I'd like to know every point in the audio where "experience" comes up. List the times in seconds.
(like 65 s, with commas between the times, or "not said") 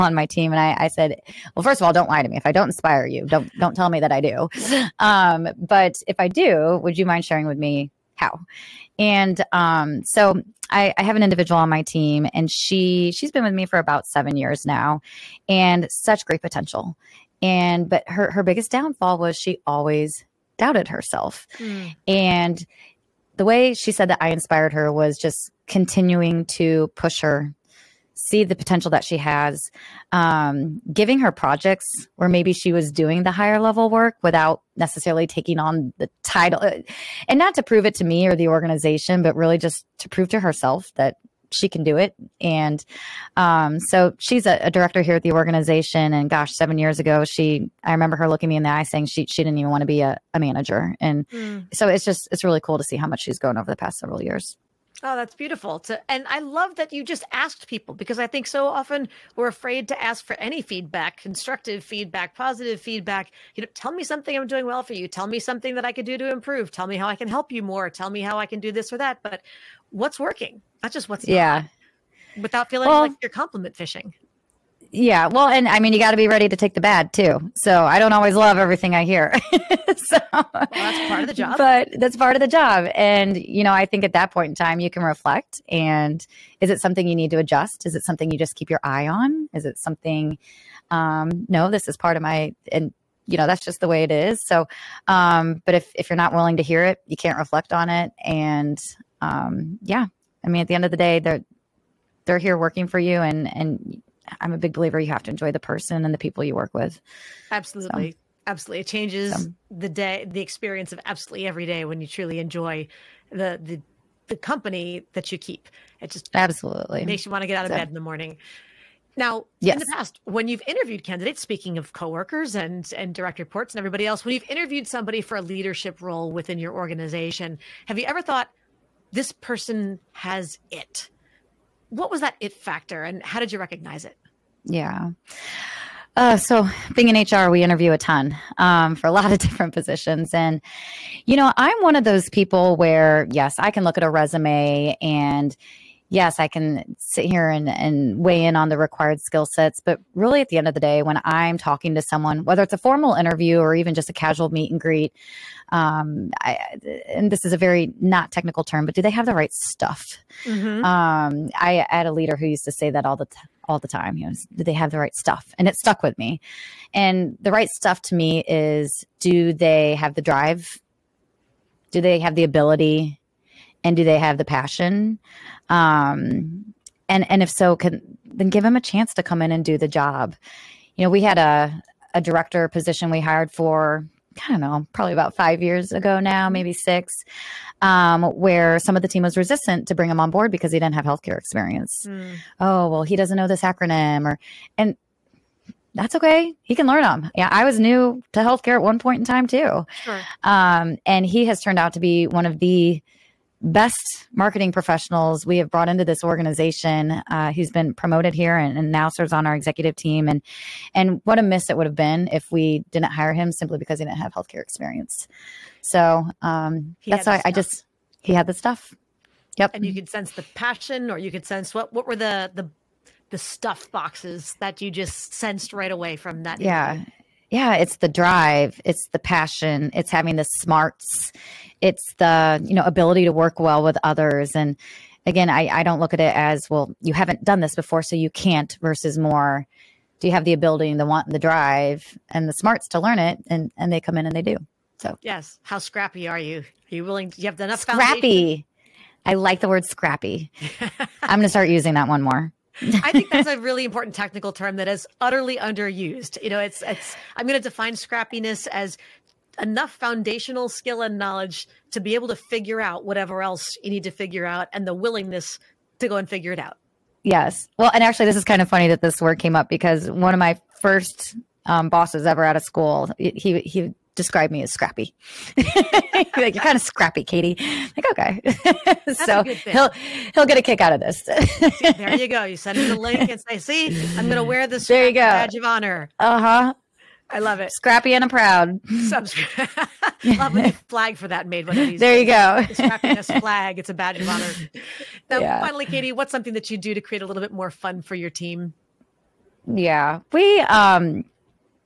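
110 s, 191 s, 214 s.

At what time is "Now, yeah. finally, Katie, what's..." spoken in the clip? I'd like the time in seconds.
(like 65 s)
295 s.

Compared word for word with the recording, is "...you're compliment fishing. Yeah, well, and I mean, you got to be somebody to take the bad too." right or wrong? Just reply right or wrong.
wrong.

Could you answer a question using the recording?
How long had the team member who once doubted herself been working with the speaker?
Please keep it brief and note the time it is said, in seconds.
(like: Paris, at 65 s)
7 years, at 13 s.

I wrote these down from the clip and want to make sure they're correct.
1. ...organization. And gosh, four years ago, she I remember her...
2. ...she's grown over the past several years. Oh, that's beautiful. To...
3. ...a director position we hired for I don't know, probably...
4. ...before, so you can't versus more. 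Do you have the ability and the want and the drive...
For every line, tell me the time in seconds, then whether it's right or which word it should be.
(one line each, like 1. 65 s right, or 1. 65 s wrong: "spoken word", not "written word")
1. 45 s wrong: "seven", not "four"
2. 53 s right
3. 182 s right
4. 237 s right.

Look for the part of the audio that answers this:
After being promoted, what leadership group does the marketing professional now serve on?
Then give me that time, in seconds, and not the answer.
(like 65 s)
209 s.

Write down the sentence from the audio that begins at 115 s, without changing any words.
It just absolutely makes you want to get out of so.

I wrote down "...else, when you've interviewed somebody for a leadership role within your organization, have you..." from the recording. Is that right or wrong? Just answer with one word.
right.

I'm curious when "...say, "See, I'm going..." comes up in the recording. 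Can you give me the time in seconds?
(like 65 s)
283 s.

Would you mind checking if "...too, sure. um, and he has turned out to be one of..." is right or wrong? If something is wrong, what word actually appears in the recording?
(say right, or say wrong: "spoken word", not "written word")
right.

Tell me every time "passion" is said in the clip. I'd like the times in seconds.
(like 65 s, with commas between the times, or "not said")
174 s, 220 s, 229 s.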